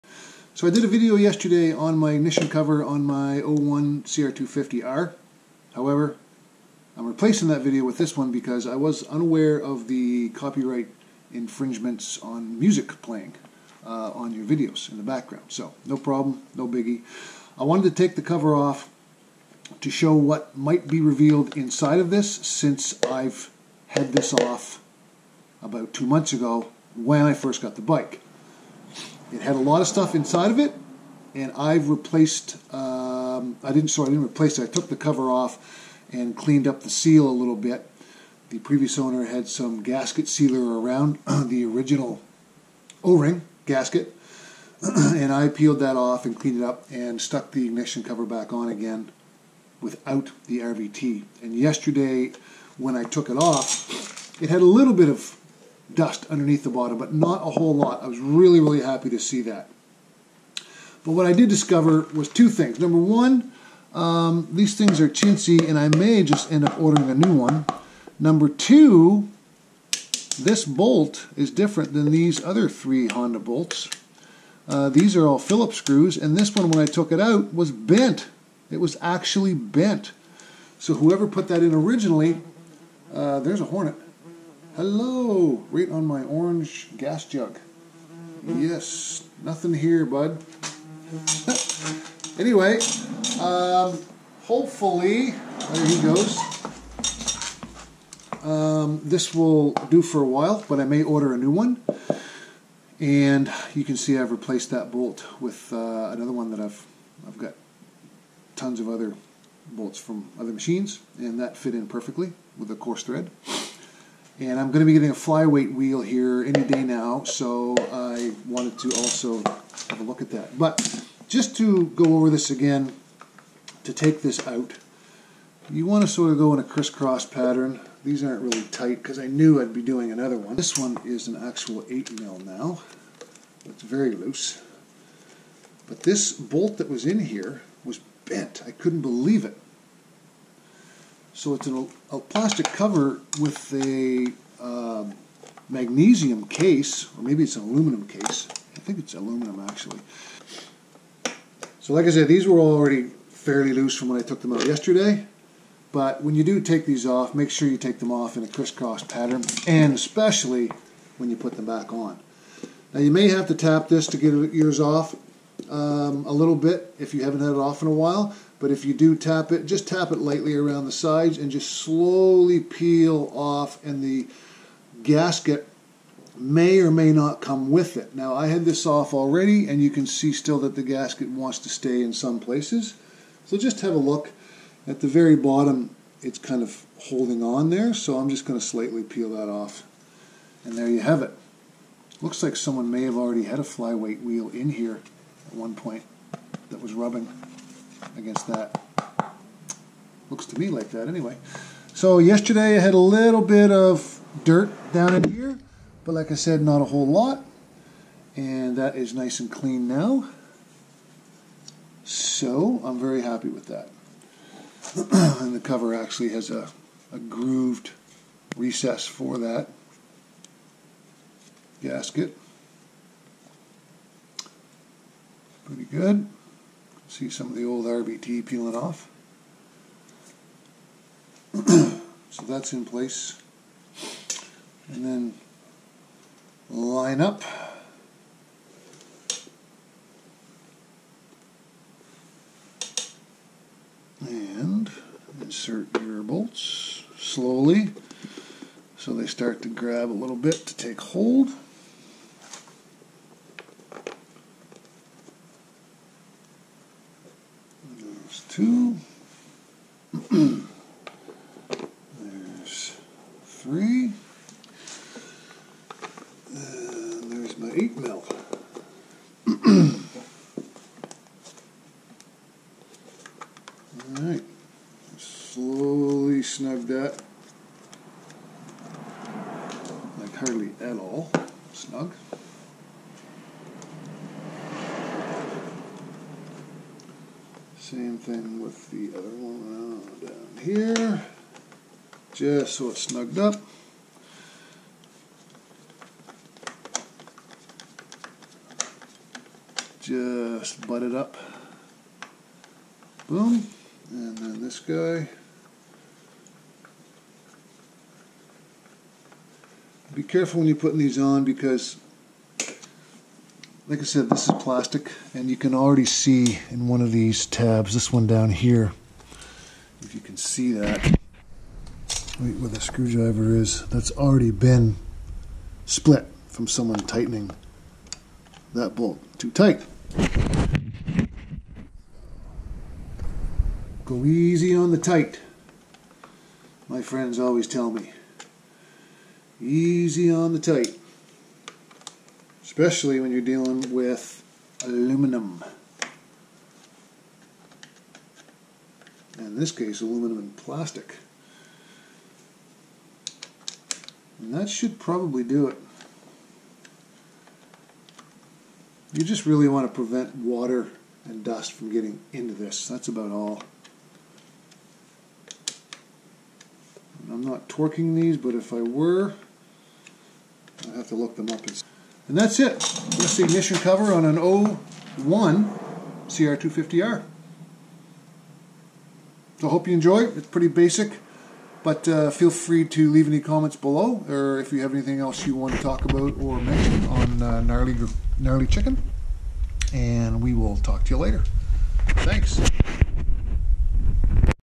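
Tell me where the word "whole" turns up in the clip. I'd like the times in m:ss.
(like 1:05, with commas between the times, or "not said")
0:57, 3:26.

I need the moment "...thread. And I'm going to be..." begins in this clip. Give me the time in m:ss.
1:53.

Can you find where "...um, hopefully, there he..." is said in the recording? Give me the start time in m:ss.
1:33.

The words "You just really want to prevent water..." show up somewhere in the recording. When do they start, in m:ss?
5:59.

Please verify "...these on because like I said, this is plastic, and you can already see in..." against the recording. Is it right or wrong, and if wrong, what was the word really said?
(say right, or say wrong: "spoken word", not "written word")
right.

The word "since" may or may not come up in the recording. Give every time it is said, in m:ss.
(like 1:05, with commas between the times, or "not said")
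0:22.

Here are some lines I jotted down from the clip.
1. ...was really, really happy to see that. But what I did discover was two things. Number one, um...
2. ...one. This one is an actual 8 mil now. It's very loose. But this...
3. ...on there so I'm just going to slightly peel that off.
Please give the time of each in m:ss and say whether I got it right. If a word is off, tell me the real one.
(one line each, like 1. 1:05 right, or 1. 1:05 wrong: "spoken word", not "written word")
1. 0:58 right
2. 2:10 right
3. 3:07 right.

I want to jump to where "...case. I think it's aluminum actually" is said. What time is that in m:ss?
2:28.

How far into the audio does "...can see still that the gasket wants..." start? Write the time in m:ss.
2:59.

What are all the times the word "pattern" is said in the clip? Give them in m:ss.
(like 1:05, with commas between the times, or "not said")
2:07, 2:39.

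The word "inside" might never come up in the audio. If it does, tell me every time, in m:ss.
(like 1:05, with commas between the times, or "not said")
0:21, 0:30.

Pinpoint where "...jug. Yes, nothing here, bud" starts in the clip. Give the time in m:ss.
1:27.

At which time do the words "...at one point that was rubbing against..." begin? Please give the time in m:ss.
3:15.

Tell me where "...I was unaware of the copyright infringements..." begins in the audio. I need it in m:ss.
0:08.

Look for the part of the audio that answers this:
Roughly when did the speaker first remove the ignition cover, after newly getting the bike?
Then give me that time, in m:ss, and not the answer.
0:25.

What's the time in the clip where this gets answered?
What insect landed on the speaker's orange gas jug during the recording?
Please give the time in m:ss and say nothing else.
1:23.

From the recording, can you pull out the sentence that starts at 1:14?
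Uh, these are all Phillips screws, and this one, when I took it out, was bent.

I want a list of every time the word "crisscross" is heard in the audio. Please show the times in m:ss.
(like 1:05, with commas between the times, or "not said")
2:06, 2:38.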